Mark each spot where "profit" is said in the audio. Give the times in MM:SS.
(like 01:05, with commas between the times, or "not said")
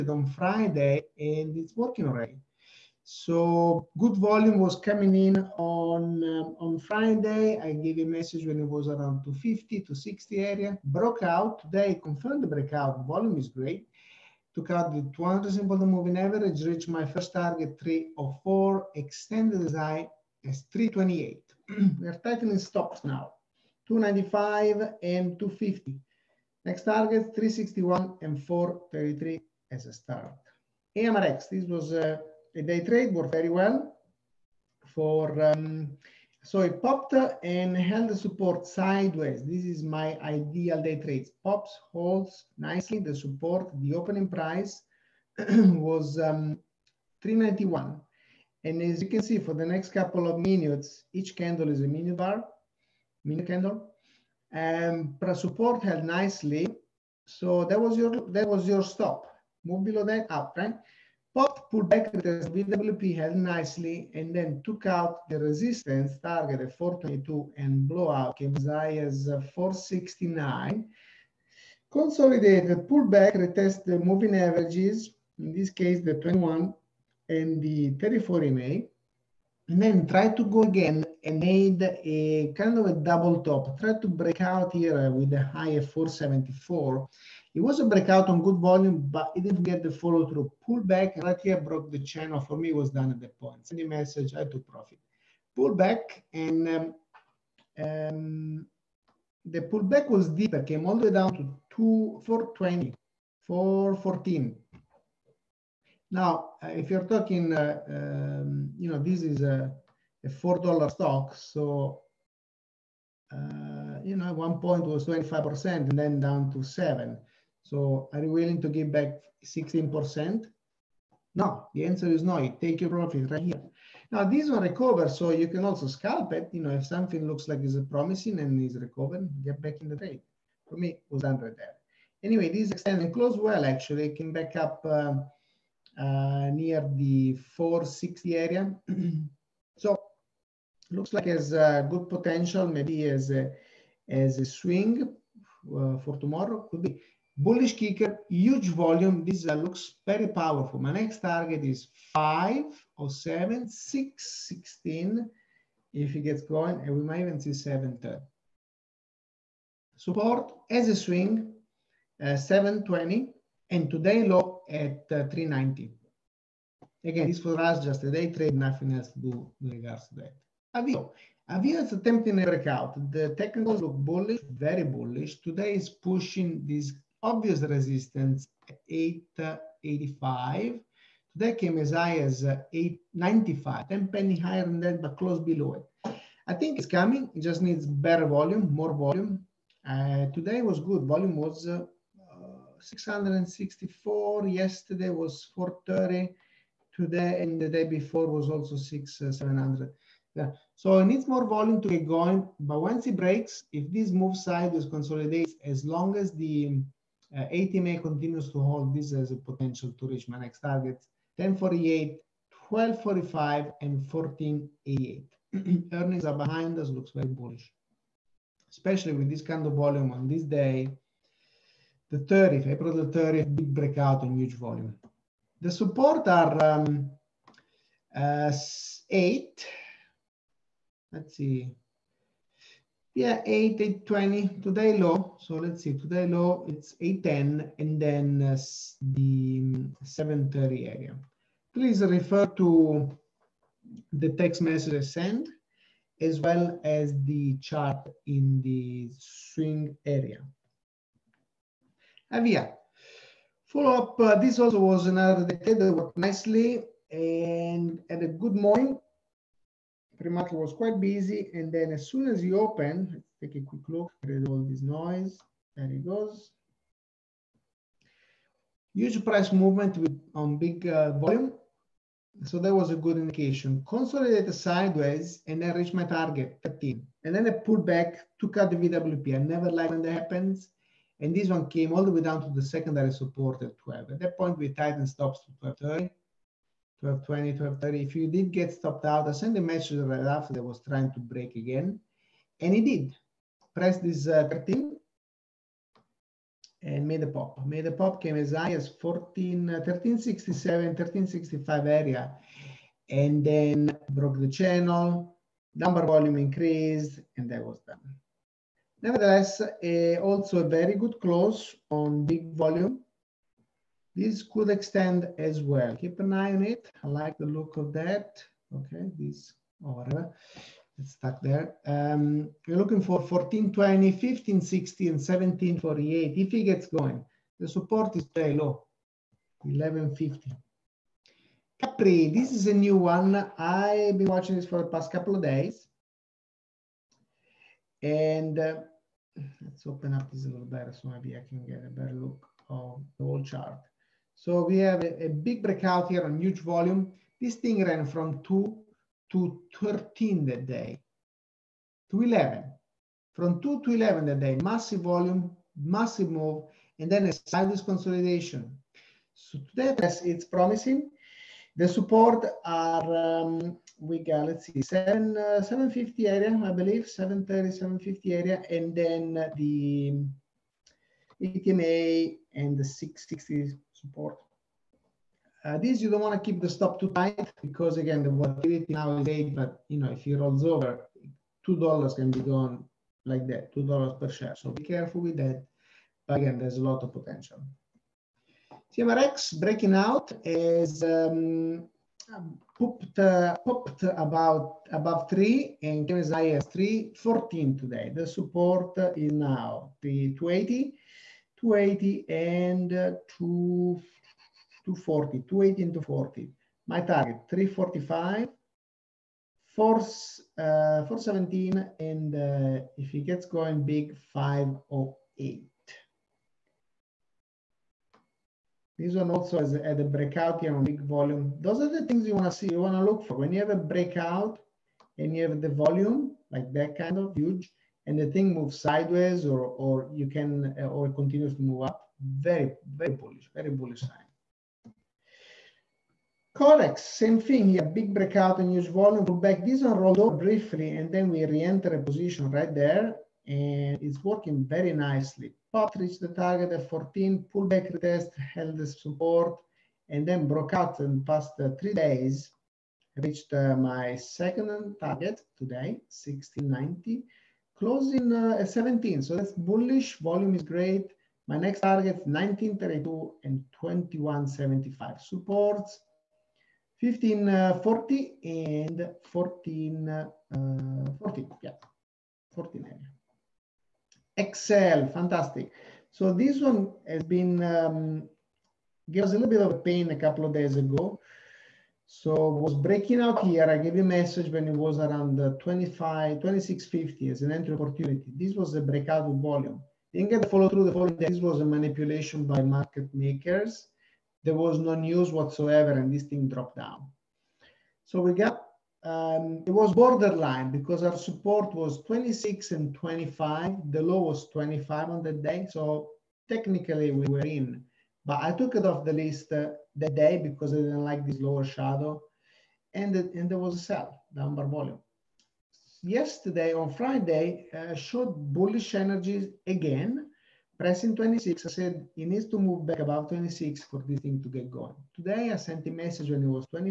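01:34, 02:02.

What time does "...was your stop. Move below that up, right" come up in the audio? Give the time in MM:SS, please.
00:58.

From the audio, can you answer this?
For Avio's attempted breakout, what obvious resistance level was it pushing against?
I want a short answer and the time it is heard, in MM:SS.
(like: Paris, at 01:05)
885, at 02:58.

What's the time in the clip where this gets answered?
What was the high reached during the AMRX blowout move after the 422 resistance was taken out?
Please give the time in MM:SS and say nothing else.
01:09.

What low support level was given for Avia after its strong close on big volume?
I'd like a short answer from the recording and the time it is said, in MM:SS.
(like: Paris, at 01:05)
1150, at 05:29.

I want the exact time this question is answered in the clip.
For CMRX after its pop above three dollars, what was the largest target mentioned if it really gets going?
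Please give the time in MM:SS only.
06:54.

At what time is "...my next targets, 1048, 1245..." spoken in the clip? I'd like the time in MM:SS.
03:30.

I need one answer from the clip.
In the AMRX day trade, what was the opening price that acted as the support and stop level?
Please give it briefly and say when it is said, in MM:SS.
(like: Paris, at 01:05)
391, at 00:47.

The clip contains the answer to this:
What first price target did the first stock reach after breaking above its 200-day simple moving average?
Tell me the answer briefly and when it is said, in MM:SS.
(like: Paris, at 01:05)
304, at 00:17.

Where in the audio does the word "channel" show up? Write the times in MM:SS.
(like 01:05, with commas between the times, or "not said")
01:31, 05:04.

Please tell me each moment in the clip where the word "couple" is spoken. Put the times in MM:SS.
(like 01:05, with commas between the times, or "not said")
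00:49, 05:35, 08:00.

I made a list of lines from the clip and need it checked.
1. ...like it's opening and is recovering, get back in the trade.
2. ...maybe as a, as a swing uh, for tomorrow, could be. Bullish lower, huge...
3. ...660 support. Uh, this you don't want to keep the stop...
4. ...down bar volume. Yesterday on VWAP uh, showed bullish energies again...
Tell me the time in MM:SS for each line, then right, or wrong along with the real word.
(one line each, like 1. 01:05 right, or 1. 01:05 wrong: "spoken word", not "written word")
1. 02:07 wrong: "promising", not "opening"
2. 02:22 wrong: "kicker", not "lower"
3. 06:12 right
4. 08:34 wrong: "Friday", not "VWAP".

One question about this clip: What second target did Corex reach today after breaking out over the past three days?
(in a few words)
1690.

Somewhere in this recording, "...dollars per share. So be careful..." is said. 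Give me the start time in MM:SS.
06:23.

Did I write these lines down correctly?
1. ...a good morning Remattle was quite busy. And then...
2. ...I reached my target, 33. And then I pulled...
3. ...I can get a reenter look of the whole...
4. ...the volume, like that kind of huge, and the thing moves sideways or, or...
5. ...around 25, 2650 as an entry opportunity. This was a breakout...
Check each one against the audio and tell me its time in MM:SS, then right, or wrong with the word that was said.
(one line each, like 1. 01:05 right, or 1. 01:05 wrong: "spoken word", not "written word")
1. 04:18 right
2. 04:35 wrong: "13", not "33"
3. 05:41 wrong: "better", not "reenter"
4. 07:05 right
5. 08:04 right.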